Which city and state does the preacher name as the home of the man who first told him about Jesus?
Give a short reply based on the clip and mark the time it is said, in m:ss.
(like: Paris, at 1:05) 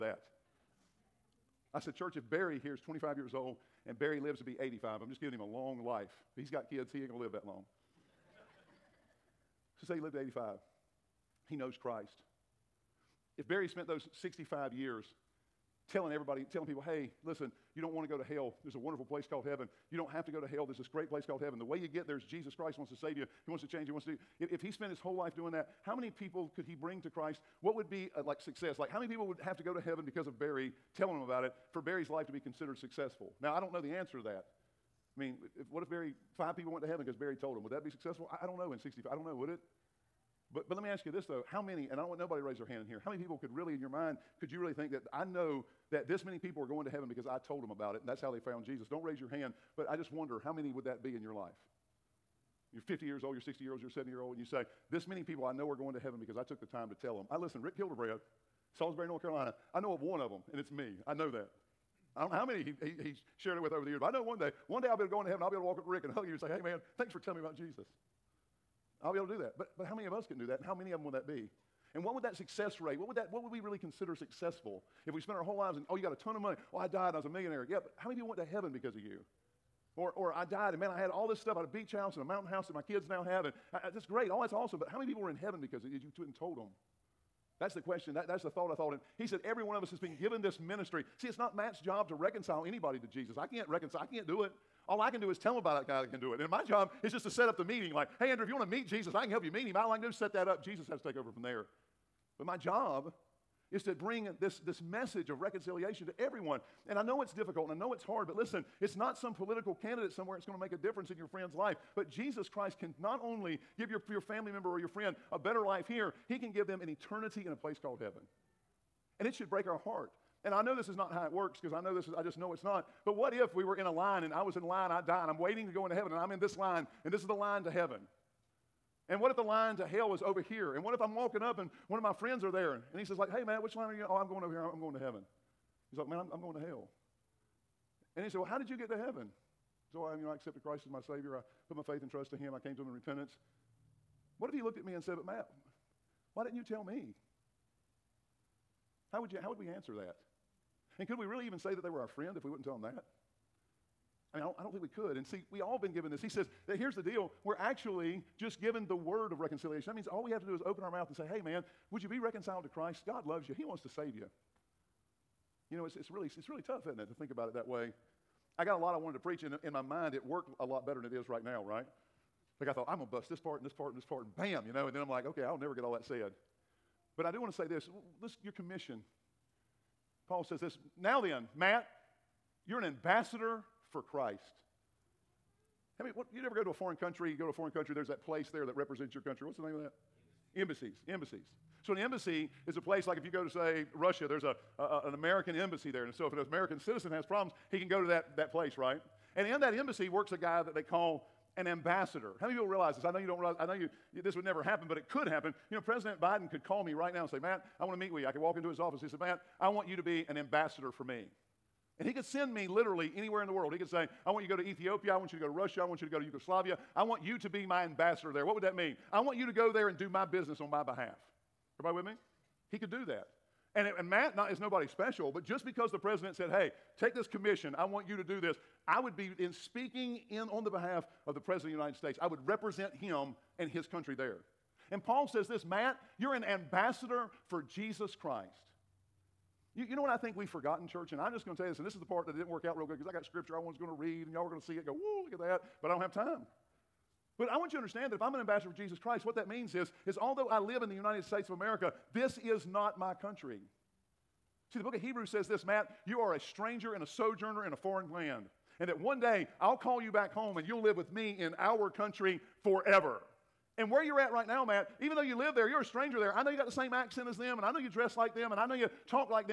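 Salisbury, North Carolina, at 0:58.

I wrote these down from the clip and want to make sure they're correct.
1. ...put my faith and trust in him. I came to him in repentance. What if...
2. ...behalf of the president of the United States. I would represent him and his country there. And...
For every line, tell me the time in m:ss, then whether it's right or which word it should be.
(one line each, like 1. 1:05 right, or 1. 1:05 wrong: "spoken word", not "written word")
1. 2:21 right
2. 3:50 right.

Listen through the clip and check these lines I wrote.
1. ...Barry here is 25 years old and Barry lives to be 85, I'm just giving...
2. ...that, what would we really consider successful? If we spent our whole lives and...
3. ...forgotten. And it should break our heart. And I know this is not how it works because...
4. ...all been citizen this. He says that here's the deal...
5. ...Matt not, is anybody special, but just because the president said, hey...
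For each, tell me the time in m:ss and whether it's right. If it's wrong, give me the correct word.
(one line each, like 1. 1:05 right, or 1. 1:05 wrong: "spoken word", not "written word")
1. 0:02 right
2. 1:13 right
3. 1:57 wrong: "heaven", not "forgotten"
4. 2:35 wrong: "given", not "citizen"
5. 3:44 wrong: "nobody", not "anybody".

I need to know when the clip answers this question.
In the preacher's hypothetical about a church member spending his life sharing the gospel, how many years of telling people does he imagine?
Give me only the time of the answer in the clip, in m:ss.
0:14.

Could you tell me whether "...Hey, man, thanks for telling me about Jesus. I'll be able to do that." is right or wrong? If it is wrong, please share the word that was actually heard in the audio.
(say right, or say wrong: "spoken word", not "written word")
right.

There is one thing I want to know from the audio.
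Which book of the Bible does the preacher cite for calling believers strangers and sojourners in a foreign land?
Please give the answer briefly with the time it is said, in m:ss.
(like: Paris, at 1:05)
Hebrews, at 4:15.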